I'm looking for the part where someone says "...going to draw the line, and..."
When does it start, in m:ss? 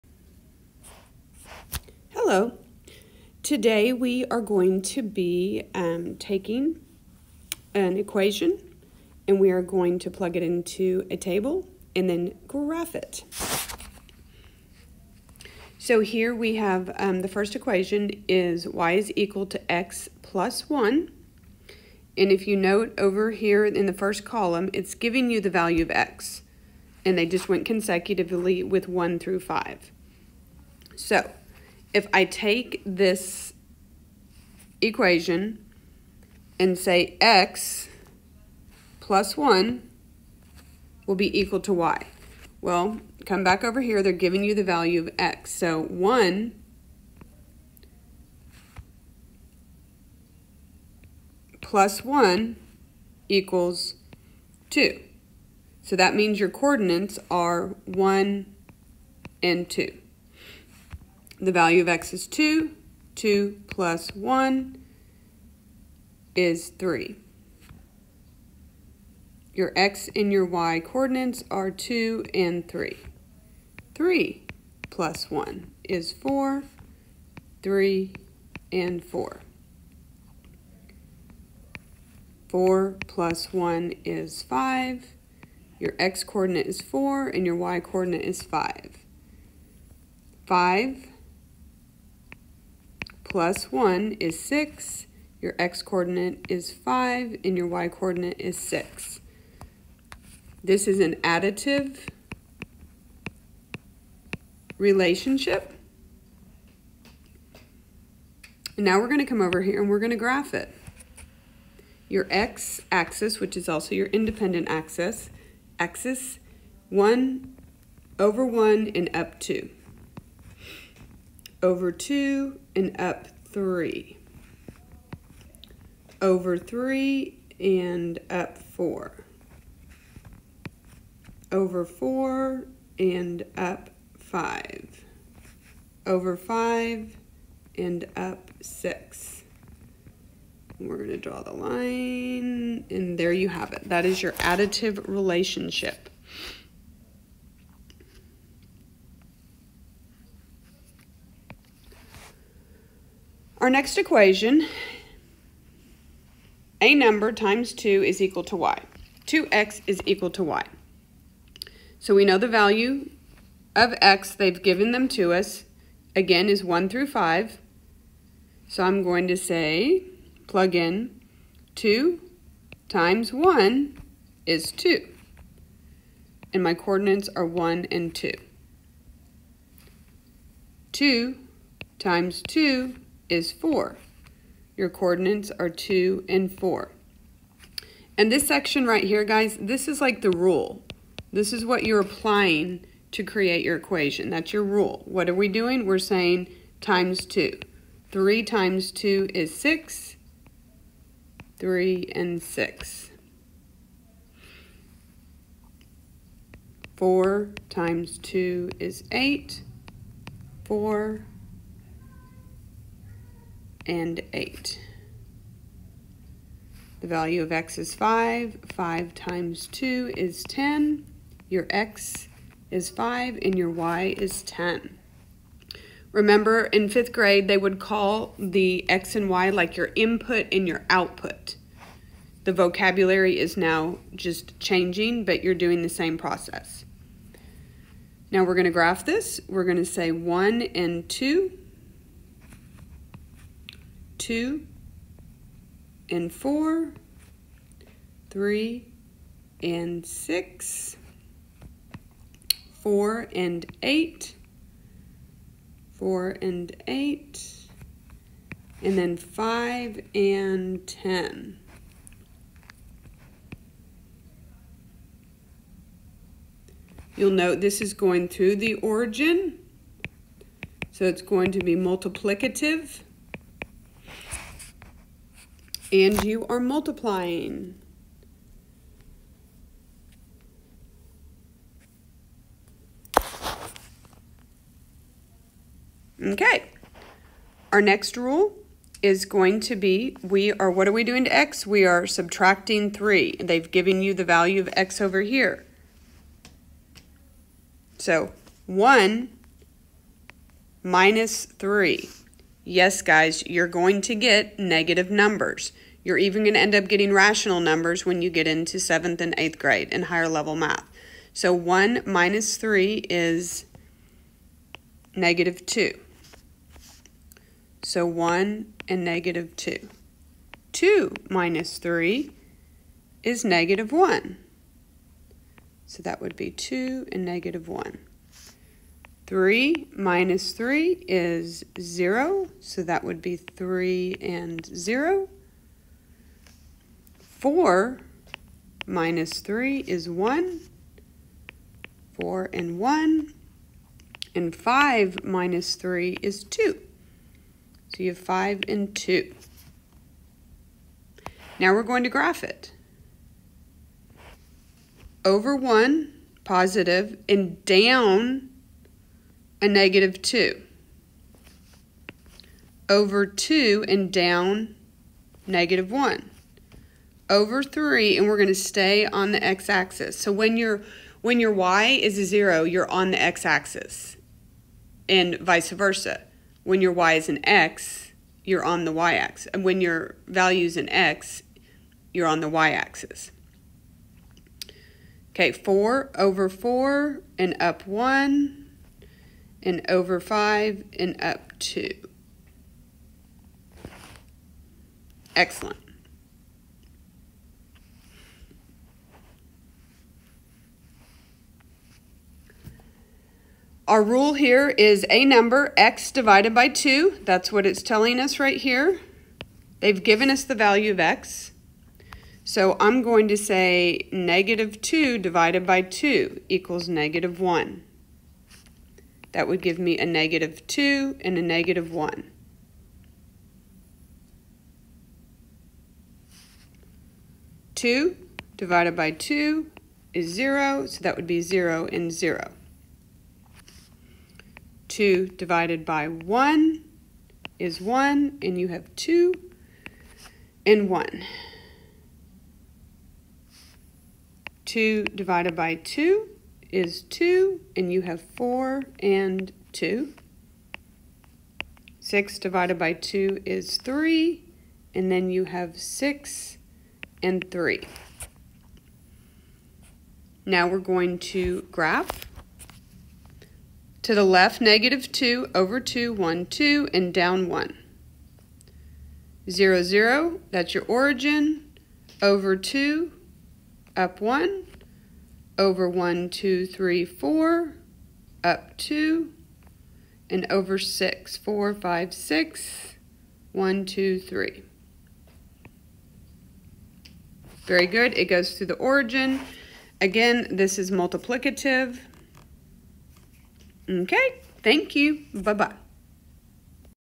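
2:20.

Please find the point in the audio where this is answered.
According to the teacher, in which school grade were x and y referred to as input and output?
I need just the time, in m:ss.
3:46.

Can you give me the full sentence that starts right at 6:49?
They've given us the value of x.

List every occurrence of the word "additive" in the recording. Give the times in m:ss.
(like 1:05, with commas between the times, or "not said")
1:41, 2:24.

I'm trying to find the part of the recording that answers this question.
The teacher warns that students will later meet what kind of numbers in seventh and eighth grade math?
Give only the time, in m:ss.
5:07.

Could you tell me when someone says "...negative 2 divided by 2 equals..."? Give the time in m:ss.
6:54.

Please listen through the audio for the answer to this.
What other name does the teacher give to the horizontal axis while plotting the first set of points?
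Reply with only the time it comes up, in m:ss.
1:54.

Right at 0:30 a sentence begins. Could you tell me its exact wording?
So if I take this equation and say x plus 1 will be equal to y.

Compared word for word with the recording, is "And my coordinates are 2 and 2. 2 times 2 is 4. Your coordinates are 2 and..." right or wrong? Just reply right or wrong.
wrong.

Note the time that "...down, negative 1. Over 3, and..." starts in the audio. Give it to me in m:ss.
6:04.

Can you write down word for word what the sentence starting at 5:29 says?
3 minus 3 is 0, so that would be 3 and 0.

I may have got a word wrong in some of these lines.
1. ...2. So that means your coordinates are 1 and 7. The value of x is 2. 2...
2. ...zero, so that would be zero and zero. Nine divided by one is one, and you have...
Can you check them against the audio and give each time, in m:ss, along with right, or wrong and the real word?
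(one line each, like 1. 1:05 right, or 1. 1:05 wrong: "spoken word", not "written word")
1. 0:54 wrong: "2", not "7"
2. 7:10 wrong: "Two", not "Nine".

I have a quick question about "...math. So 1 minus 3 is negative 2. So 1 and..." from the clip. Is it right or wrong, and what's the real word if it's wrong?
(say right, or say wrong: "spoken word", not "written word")
right.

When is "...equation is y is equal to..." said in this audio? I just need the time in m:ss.
0:17.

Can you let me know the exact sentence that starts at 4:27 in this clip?
You'll note this is going through the origin, so it's going to be multiplicative and you are multiplying.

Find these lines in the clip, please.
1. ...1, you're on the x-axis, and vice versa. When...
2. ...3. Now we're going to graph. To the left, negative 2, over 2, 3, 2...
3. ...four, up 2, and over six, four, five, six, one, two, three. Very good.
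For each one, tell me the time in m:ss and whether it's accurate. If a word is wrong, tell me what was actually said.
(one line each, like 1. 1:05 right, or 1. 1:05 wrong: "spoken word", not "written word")
1. 6:12 wrong: "0", not "1"
2. 7:37 wrong: "1", not "3"
3. 7:57 right.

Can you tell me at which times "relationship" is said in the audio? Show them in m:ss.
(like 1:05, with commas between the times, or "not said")
1:44, 2:25.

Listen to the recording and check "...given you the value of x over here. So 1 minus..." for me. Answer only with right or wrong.
right.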